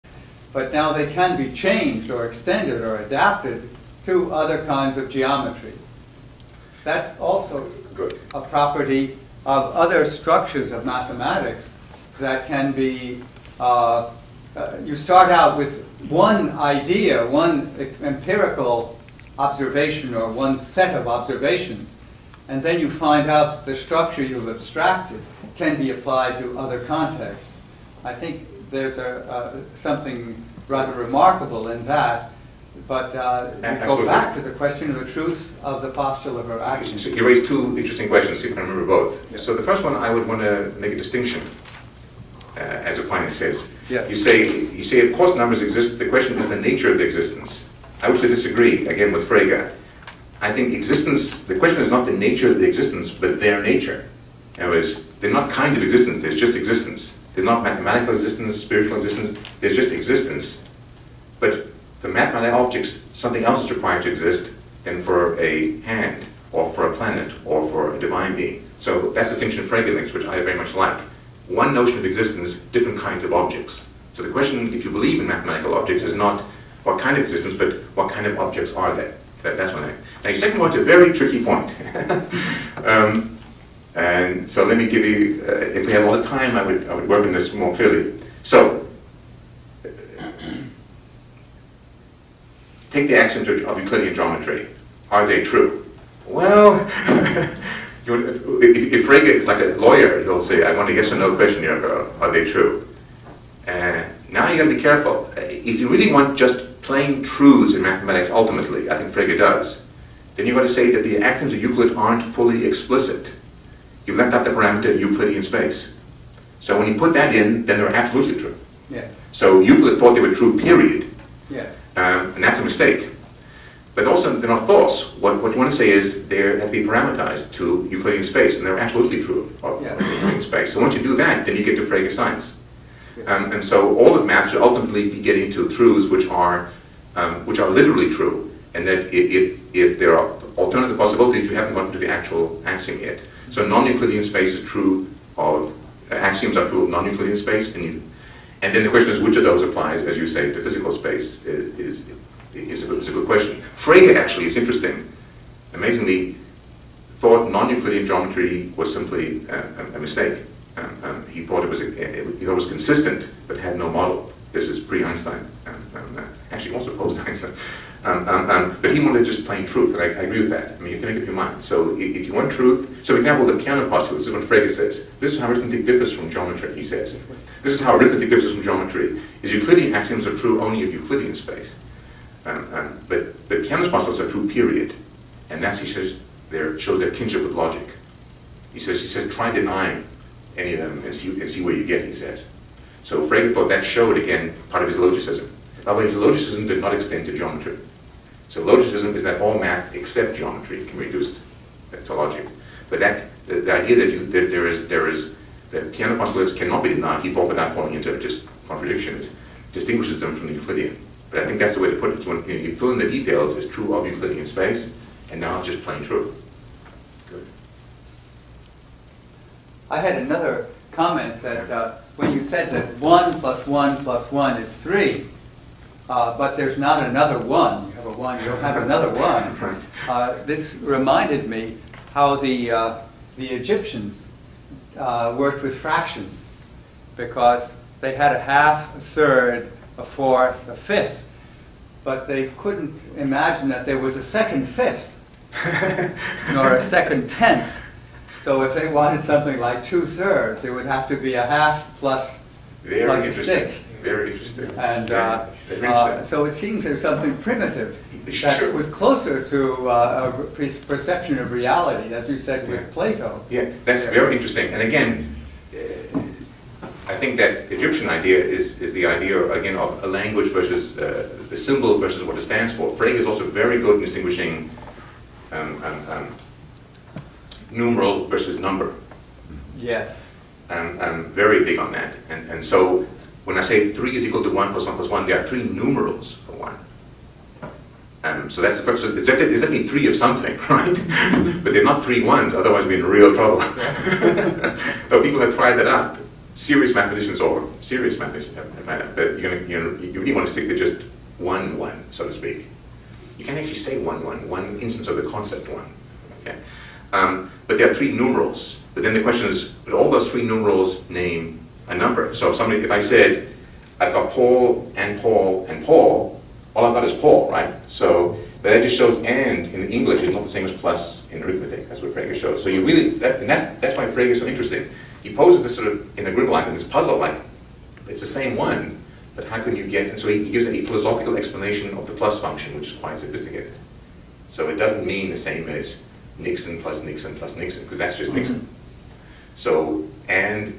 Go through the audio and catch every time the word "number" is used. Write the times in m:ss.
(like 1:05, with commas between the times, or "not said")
0:45, 4:38, 5:11.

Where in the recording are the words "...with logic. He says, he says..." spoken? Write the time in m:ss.
3:07.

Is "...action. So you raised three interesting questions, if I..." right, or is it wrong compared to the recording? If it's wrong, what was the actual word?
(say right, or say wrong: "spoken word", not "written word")
wrong: "two", not "three".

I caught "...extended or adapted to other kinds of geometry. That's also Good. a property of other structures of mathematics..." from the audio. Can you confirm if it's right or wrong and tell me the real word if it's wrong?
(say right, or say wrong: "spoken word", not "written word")
right.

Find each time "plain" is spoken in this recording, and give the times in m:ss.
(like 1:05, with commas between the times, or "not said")
1:46, 2:49, 3:35.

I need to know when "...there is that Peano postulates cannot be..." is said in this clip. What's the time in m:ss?
3:24.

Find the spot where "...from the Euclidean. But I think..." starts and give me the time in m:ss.
3:30.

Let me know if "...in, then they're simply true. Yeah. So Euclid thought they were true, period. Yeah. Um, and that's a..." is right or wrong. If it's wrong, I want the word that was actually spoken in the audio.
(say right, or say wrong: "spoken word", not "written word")
wrong: "absolutely", not "simply".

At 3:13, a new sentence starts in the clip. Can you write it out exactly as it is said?
So Frege thought that showed, again, part of his logicism.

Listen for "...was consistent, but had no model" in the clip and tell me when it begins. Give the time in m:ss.
2:42.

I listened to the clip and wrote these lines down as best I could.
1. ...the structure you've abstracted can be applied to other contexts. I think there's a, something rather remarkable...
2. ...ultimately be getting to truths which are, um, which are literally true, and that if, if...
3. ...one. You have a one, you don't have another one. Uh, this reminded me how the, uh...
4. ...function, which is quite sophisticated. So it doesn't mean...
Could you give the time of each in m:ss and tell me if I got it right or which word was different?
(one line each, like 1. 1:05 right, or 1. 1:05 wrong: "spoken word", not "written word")
1. 0:23 right
2. 2:14 right
3. 3:47 right
4. 5:32 right.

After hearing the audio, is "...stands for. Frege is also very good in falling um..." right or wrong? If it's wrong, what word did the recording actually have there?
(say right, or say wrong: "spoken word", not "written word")
wrong: "distinguishing", not "falling".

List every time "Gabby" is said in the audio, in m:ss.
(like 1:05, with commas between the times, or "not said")
not said.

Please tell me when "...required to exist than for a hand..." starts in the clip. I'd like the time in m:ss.
1:03.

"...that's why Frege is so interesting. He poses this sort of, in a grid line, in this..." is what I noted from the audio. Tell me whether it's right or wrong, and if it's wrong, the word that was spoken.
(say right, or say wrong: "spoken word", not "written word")
right.